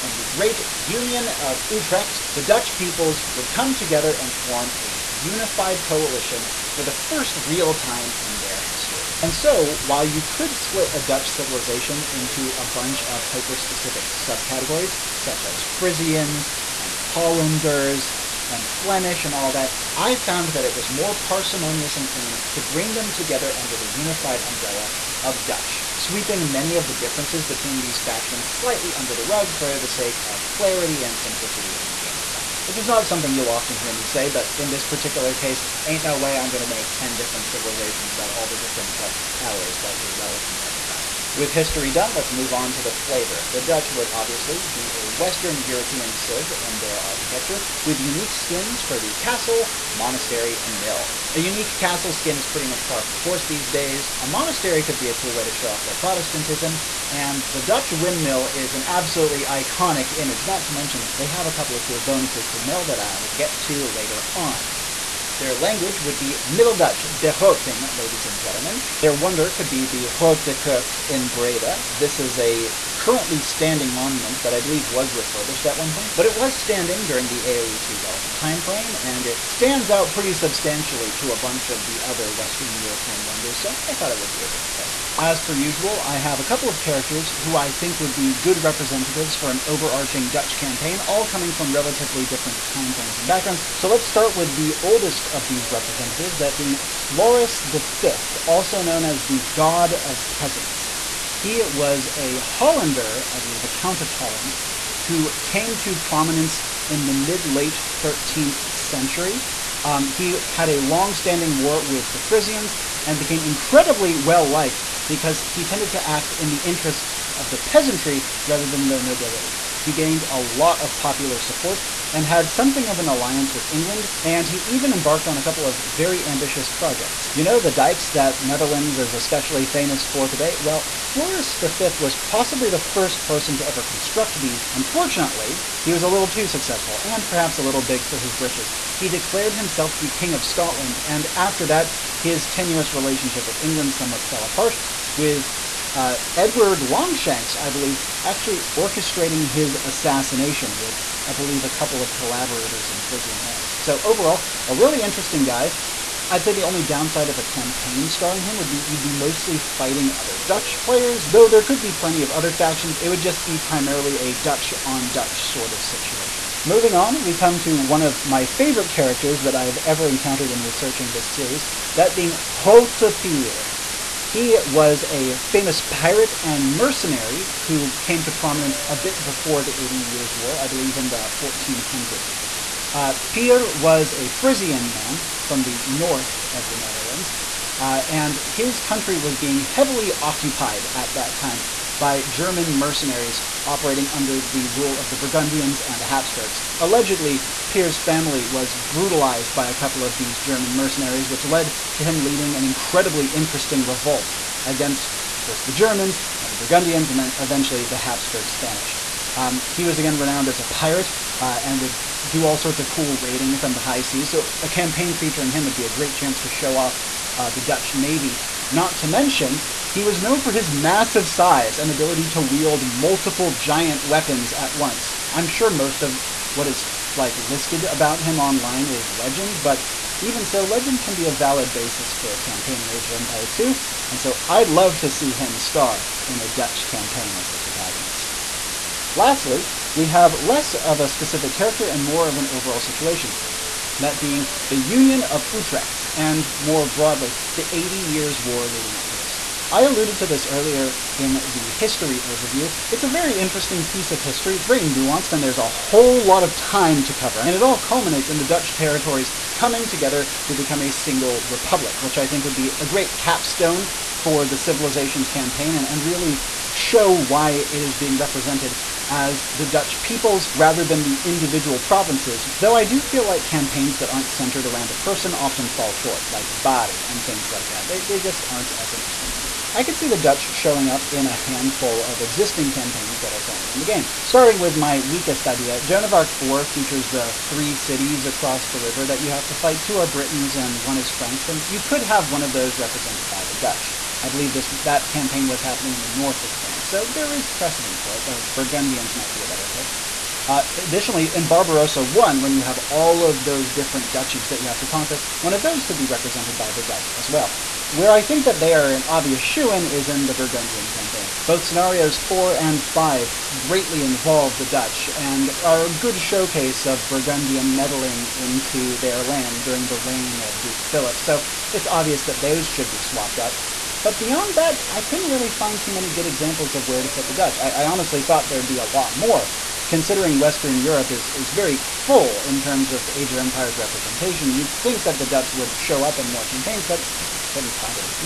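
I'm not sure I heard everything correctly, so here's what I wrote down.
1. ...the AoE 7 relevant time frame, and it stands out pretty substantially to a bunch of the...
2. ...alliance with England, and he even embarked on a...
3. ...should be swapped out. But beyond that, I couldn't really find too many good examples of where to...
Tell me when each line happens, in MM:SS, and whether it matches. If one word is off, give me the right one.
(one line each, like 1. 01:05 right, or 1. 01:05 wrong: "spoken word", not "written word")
1. 01:17 wrong: "2", not "7"
2. 02:03 right
3. 05:22 right.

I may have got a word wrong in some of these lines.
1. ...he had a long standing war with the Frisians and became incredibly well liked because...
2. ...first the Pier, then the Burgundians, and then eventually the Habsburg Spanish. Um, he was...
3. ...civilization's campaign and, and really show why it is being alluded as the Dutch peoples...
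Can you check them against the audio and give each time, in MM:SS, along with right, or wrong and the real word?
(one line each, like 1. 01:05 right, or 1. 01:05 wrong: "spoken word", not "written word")
1. 01:50 right
2. 03:25 wrong: "Germans", not "Pier"
3. 04:24 wrong: "represented", not "alluded".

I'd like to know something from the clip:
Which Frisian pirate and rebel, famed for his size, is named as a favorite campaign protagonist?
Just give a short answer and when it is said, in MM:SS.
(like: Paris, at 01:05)
Grote Pier, at 02:52.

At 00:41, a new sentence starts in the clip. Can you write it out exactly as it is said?
With history done, let's move on to the flavor.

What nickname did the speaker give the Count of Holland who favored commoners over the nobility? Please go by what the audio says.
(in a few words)
God of Peasants.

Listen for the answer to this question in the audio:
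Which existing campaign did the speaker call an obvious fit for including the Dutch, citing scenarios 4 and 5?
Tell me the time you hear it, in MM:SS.
05:10.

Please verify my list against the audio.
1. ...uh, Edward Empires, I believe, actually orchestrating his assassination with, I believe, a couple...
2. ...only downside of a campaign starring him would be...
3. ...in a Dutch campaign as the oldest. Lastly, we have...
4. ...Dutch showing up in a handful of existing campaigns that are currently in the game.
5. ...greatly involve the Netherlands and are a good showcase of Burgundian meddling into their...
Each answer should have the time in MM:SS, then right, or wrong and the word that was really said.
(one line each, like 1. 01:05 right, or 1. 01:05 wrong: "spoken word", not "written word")
1. 02:25 wrong: "Longshanks", not "Empires"
2. 02:36 right
3. 03:56 wrong: "protagonist", not "oldest"
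4. 04:40 right
5. 05:13 wrong: "Dutch", not "Netherlands".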